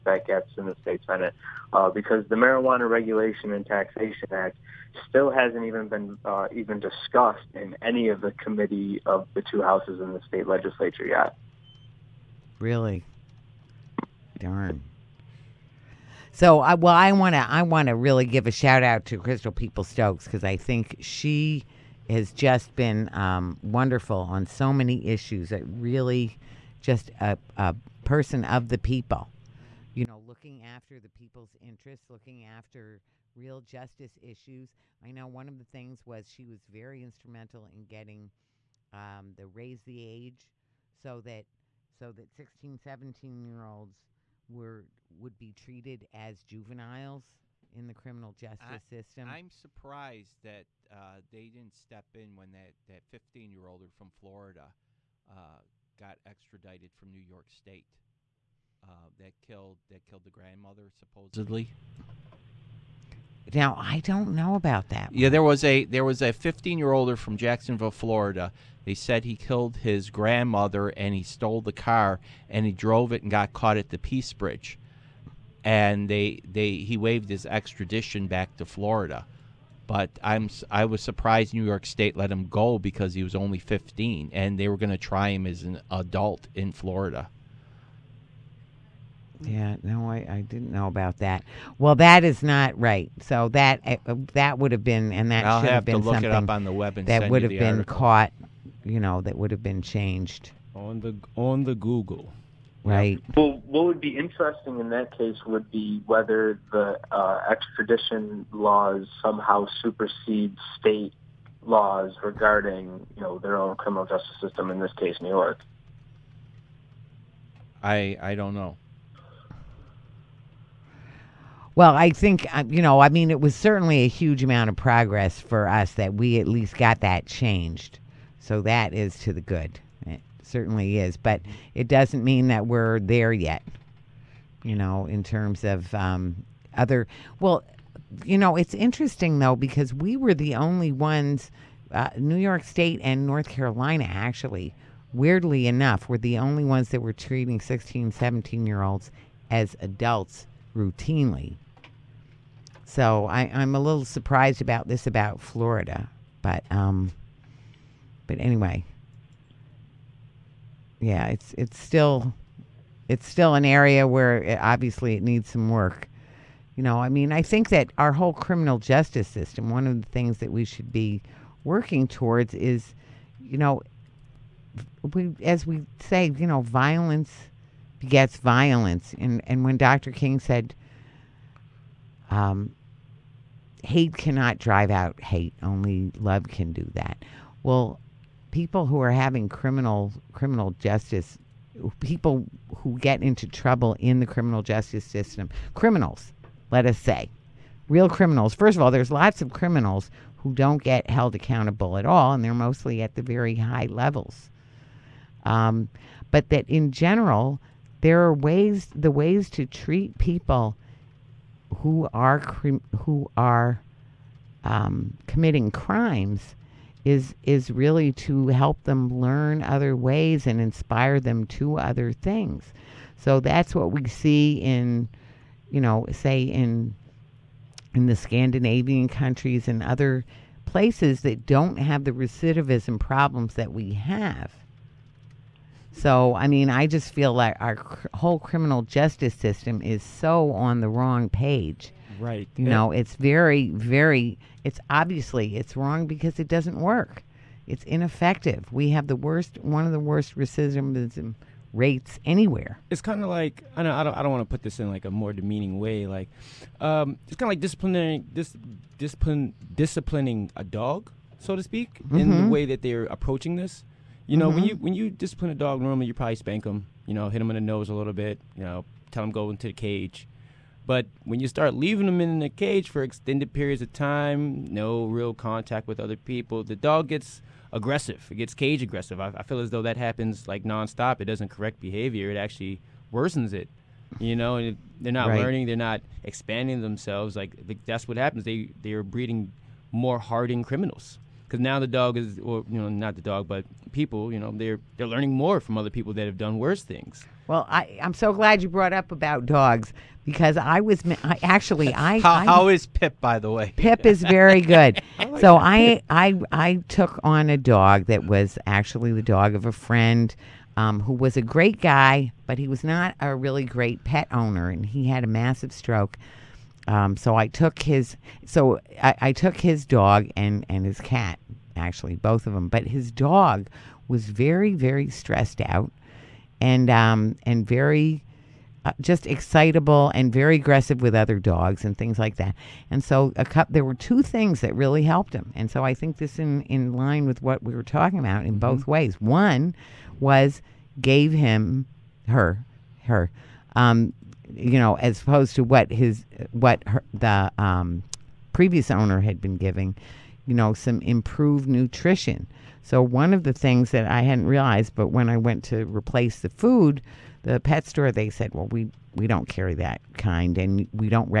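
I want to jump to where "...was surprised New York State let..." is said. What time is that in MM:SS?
01:20.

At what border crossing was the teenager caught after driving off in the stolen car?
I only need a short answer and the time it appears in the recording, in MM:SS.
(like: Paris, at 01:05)
Peace Bridge, at 01:13.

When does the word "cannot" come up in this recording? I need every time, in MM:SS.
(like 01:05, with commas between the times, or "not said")
03:04.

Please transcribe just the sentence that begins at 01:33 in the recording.
So that uh, that would have been, and that I'll should have, have been something that would have been article.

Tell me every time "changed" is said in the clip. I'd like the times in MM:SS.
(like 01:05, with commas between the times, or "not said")
01:39, 02:07.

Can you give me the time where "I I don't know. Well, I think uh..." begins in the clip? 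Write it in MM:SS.
01:57.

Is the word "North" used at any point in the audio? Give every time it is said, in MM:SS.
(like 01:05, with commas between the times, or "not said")
02:23.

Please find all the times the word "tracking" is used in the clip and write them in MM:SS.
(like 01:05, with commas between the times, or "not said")
not said.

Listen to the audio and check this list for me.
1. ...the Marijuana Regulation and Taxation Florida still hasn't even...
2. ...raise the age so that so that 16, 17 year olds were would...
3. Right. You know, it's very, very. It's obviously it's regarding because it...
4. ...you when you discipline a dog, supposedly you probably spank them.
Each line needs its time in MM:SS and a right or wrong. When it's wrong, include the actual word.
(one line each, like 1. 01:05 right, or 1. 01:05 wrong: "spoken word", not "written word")
1. 00:02 wrong: "Act", not "Florida"
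2. 00:39 right
3. 04:02 wrong: "wrong", not "regarding"
4. 04:24 wrong: "normally", not "supposedly".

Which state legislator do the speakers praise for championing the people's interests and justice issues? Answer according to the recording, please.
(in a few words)
Crystal Peoples-Stokes.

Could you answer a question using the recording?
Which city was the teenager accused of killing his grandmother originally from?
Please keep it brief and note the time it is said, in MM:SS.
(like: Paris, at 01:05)
Jacksonville, at 01:07.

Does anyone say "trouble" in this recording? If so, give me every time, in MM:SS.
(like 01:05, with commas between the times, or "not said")
03:13.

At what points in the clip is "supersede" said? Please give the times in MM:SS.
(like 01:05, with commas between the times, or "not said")
01:49.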